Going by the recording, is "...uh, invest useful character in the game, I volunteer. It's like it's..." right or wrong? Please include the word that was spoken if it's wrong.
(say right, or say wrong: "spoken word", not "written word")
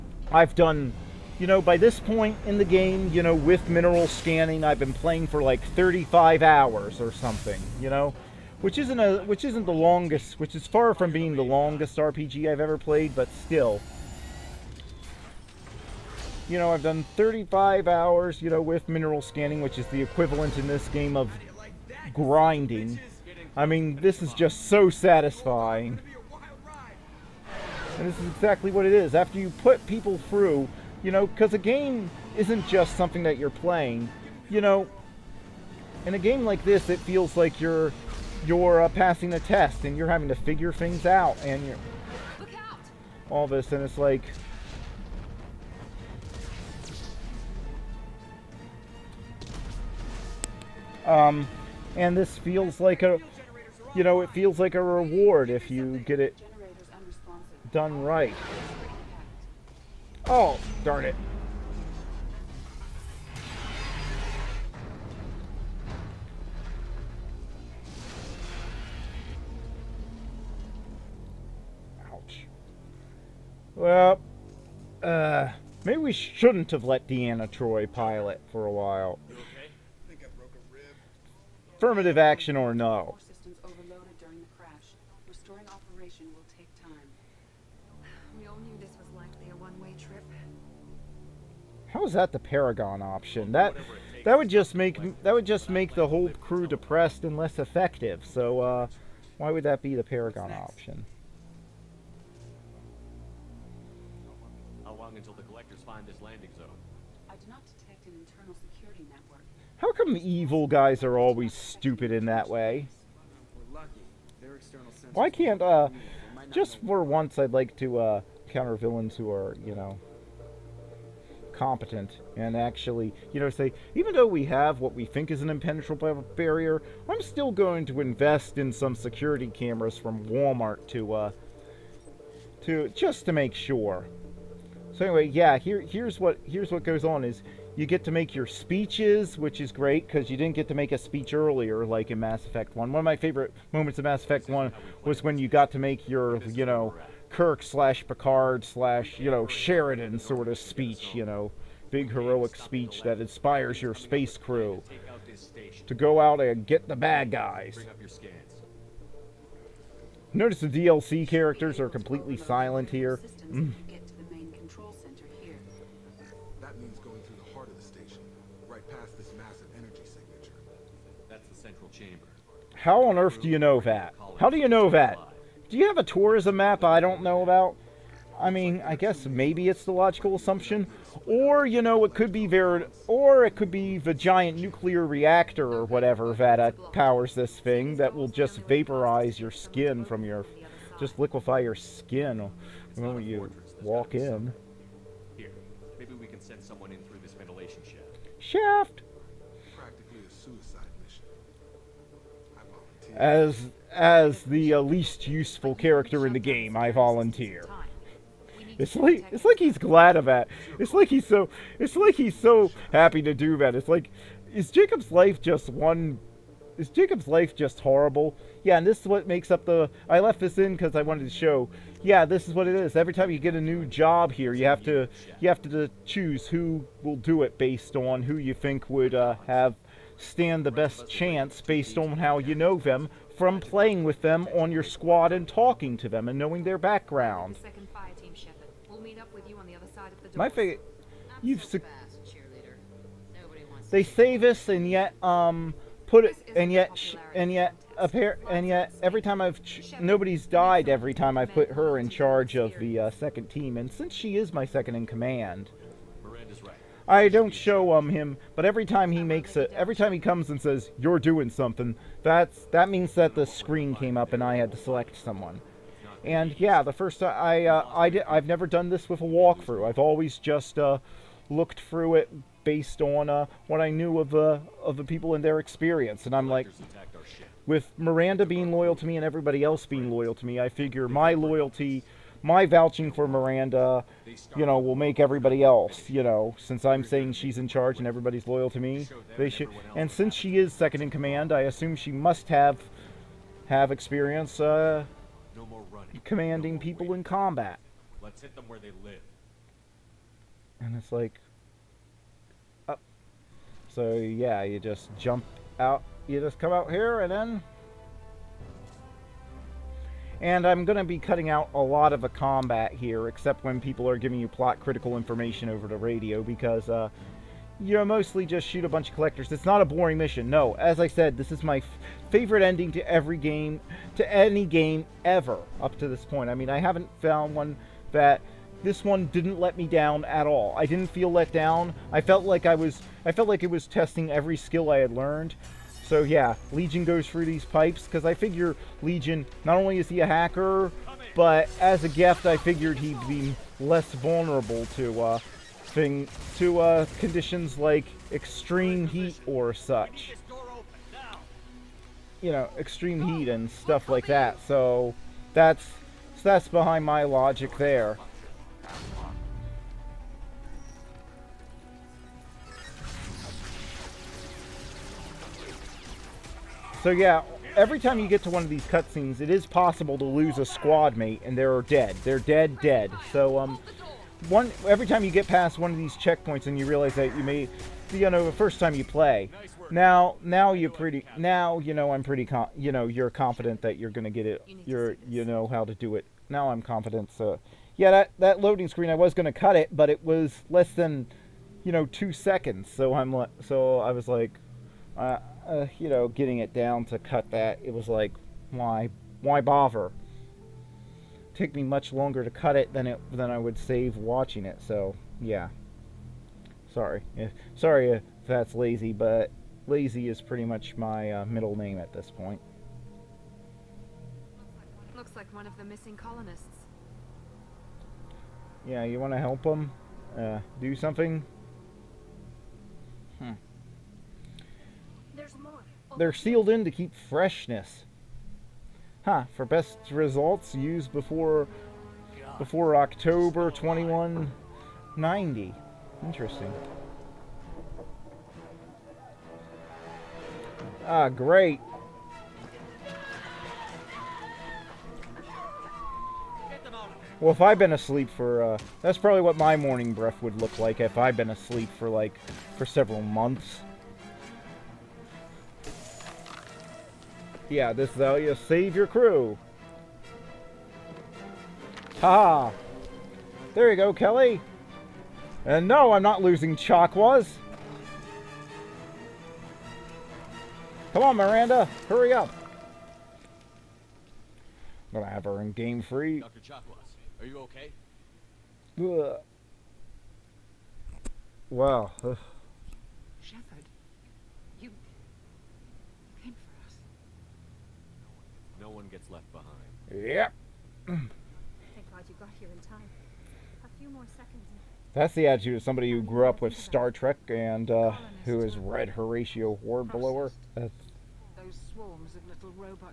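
wrong: "least", not "invest".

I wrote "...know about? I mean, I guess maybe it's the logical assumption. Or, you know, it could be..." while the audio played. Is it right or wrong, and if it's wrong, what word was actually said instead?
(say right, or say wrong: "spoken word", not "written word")
right.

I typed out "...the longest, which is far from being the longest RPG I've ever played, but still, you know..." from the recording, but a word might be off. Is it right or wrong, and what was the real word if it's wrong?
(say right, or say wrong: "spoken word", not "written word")
right.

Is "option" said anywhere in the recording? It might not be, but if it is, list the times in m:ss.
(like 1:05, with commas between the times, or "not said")
1:33, 1:40.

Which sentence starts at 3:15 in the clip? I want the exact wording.
Here, maybe we can send someone in through this ventilation shaft.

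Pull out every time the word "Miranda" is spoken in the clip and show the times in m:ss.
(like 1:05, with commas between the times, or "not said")
4:37, 4:43, 7:51.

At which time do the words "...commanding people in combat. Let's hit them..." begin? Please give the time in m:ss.
4:56.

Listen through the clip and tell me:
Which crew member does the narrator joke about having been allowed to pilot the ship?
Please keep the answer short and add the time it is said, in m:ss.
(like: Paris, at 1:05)
Deanna Troi, at 1:17.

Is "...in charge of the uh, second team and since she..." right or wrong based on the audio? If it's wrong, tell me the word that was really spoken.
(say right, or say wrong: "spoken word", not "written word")
right.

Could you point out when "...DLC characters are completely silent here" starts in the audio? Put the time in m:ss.
2:40.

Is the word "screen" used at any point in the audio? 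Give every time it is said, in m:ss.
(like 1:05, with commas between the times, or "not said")
4:23, 6:28.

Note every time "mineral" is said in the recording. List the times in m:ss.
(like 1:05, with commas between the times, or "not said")
0:03, 0:18.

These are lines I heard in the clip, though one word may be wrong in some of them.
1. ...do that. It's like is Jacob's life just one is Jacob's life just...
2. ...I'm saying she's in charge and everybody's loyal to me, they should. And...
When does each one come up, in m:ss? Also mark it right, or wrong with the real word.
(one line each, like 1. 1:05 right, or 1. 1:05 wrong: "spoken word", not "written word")
1. 3:33 right
2. 4:46 right.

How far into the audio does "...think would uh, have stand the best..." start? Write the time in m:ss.
3:48.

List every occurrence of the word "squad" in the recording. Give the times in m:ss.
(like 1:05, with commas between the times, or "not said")
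3:54, 6:10.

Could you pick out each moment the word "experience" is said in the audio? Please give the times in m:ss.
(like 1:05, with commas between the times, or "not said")
4:35, 4:53.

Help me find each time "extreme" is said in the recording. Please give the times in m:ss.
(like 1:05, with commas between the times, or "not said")
5:48, 5:52.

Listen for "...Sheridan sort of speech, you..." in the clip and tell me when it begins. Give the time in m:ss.
2:29.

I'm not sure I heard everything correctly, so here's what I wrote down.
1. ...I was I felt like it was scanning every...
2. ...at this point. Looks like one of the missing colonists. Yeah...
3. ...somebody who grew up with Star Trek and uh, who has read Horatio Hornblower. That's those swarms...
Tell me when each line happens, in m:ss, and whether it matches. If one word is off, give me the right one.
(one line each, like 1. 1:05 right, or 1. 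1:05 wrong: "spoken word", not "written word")
1. 5:32 wrong: "testing", not "scanning"
2. 6:51 right
3. 8:15 right.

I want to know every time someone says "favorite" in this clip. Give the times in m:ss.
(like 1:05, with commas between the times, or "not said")
2:23, 4:00, 5:22.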